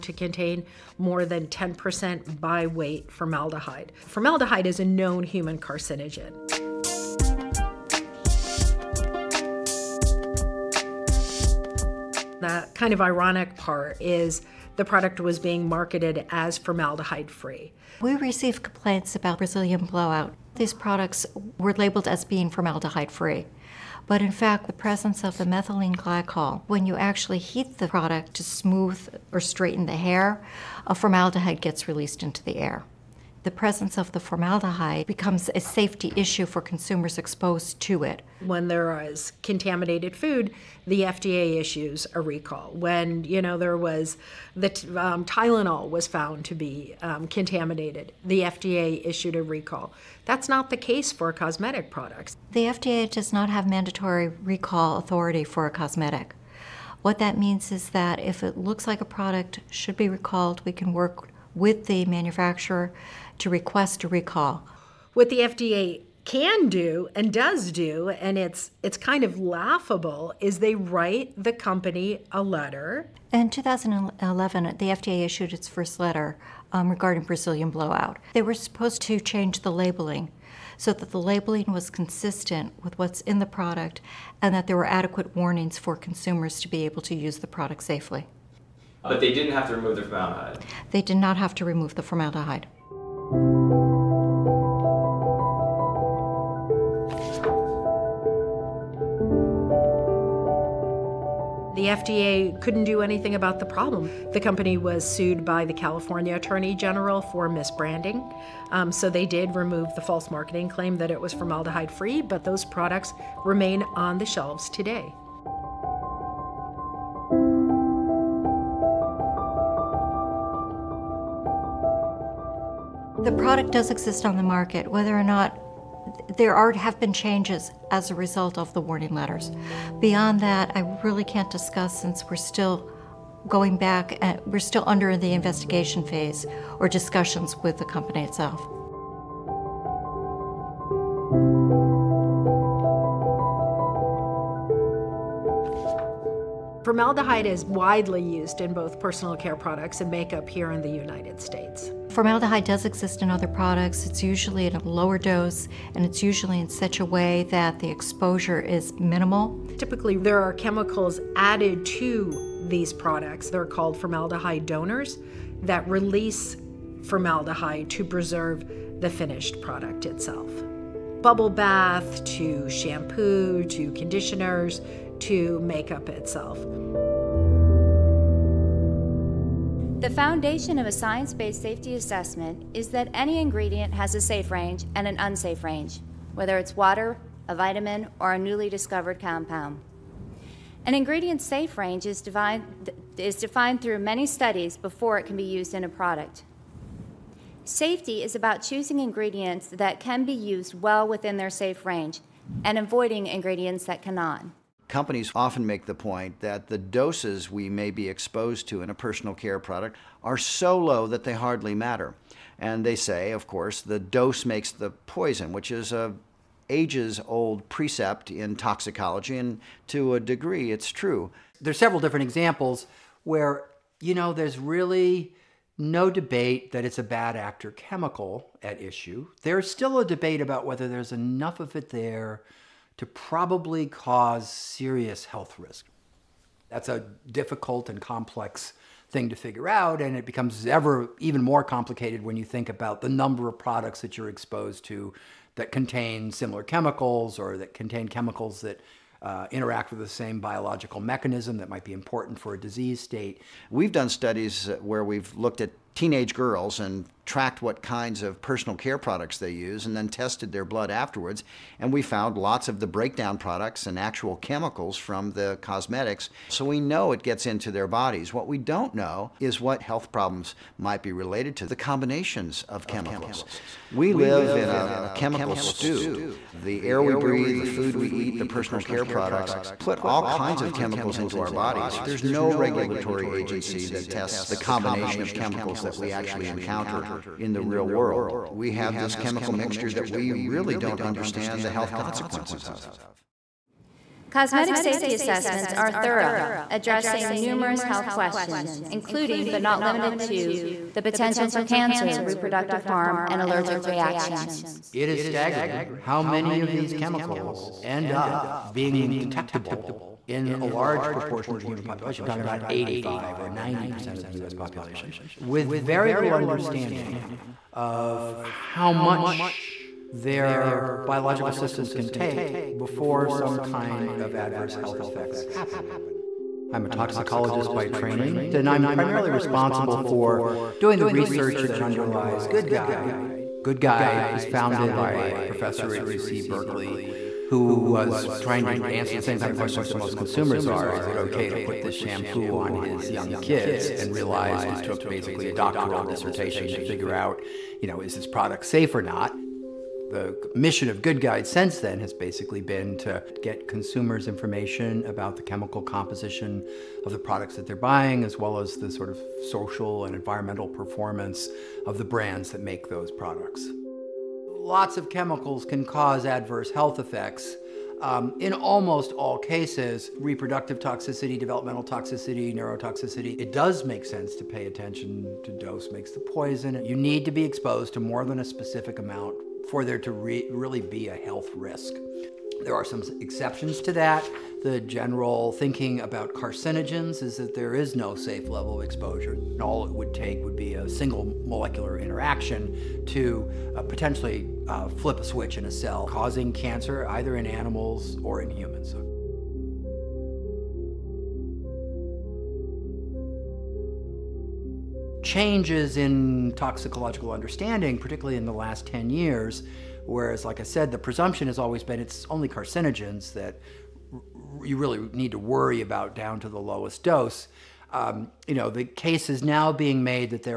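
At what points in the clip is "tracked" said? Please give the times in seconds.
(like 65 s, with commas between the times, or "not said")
257 s.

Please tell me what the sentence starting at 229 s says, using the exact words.
There's still a debate about whether there's enough of it there to probably cause serious health risk.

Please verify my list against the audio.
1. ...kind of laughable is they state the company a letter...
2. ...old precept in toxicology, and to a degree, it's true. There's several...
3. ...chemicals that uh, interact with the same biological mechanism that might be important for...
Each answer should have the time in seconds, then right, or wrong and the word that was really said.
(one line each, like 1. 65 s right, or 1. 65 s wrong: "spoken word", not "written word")
1. 68 s wrong: "write", not "state"
2. 217 s right
3. 248 s right.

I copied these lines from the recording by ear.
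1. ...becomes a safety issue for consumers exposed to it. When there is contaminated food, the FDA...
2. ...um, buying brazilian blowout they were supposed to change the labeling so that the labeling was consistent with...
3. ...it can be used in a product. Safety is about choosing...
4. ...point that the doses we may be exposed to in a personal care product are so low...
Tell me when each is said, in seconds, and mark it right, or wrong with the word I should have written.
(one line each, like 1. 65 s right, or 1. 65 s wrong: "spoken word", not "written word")
1. 35 s right
2. 76 s wrong: "regarding", not "buying"
3. 195 s right
4. 205 s right.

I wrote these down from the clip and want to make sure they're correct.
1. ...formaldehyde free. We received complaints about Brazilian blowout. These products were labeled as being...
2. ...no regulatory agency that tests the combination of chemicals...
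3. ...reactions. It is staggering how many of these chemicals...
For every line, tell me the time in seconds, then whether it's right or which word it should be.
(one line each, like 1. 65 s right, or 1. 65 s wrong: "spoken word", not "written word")
1. 16 s right
2. 282 s right
3. 303 s right.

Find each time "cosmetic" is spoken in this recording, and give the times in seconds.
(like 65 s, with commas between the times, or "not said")
51 s, 55 s, 265 s, 294 s.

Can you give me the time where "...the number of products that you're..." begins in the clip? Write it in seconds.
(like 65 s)
243 s.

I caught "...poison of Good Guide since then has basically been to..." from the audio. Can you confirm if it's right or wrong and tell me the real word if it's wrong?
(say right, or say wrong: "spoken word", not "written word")
wrong: "mission", not "poison".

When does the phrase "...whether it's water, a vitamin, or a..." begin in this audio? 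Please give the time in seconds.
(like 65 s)
186 s.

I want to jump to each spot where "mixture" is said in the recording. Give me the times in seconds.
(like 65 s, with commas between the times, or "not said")
289 s.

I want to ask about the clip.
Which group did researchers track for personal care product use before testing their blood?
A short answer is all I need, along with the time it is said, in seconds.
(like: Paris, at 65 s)
teenage girls, at 255 s.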